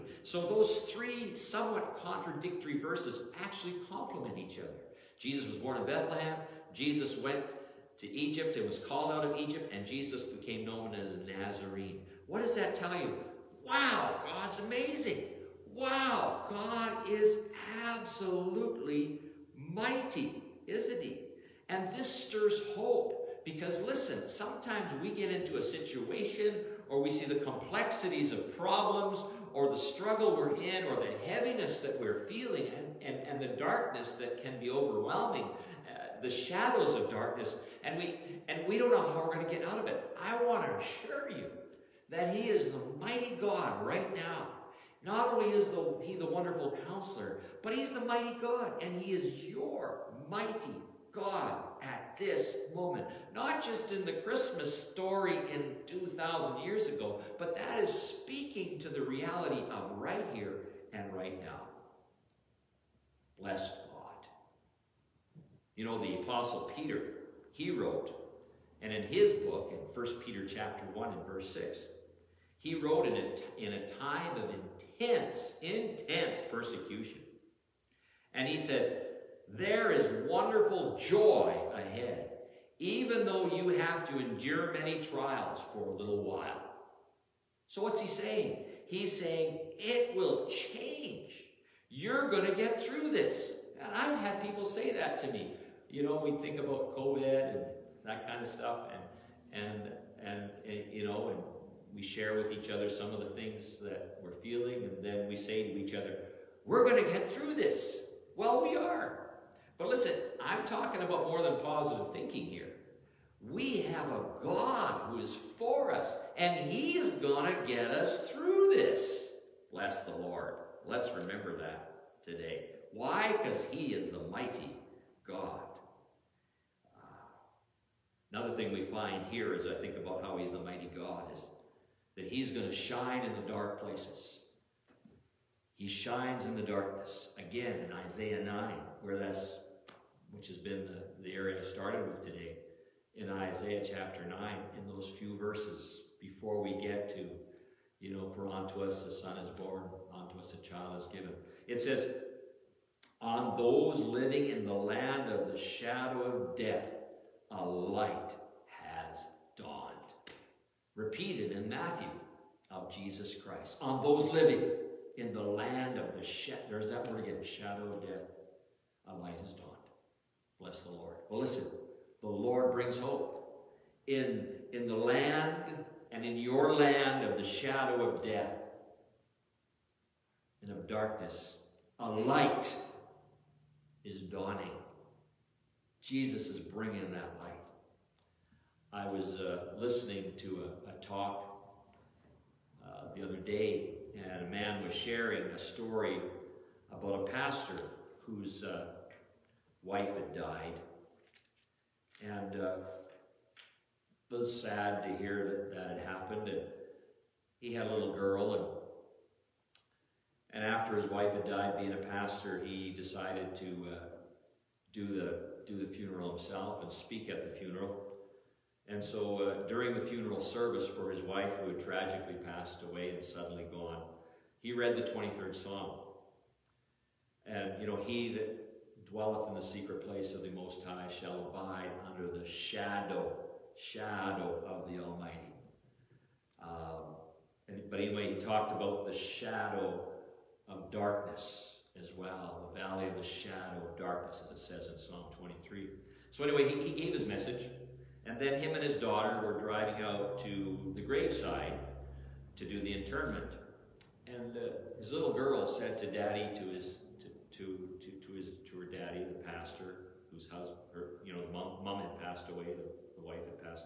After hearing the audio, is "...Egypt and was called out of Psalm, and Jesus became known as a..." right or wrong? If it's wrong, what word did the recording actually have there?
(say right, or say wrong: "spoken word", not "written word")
wrong: "Egypt", not "Psalm".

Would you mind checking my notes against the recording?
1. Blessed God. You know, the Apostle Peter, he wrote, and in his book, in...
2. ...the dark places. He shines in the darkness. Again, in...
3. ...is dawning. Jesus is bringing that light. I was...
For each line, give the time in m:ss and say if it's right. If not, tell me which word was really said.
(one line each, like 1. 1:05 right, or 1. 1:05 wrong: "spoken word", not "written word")
1. 1:03 right
2. 2:13 right
3. 3:04 right.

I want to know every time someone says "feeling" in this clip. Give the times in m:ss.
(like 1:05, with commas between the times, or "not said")
0:32, 1:44.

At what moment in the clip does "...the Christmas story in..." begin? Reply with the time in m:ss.
0:54.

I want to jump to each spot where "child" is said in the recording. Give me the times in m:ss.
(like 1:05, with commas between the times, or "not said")
2:30.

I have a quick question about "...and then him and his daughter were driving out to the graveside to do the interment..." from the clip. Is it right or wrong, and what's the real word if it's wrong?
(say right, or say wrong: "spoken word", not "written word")
right.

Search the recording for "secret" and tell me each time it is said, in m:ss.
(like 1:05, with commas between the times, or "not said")
3:49.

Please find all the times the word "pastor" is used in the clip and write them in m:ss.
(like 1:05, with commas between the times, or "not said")
3:17, 3:31, 4:19.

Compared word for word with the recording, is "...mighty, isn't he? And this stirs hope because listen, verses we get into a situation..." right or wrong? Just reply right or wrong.
wrong.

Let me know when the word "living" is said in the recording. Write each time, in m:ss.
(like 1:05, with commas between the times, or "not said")
2:34, 2:44.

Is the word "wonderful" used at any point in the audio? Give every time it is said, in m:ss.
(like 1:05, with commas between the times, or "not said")
0:46, 1:20.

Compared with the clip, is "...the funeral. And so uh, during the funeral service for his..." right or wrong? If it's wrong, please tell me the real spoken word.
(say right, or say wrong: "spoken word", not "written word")
right.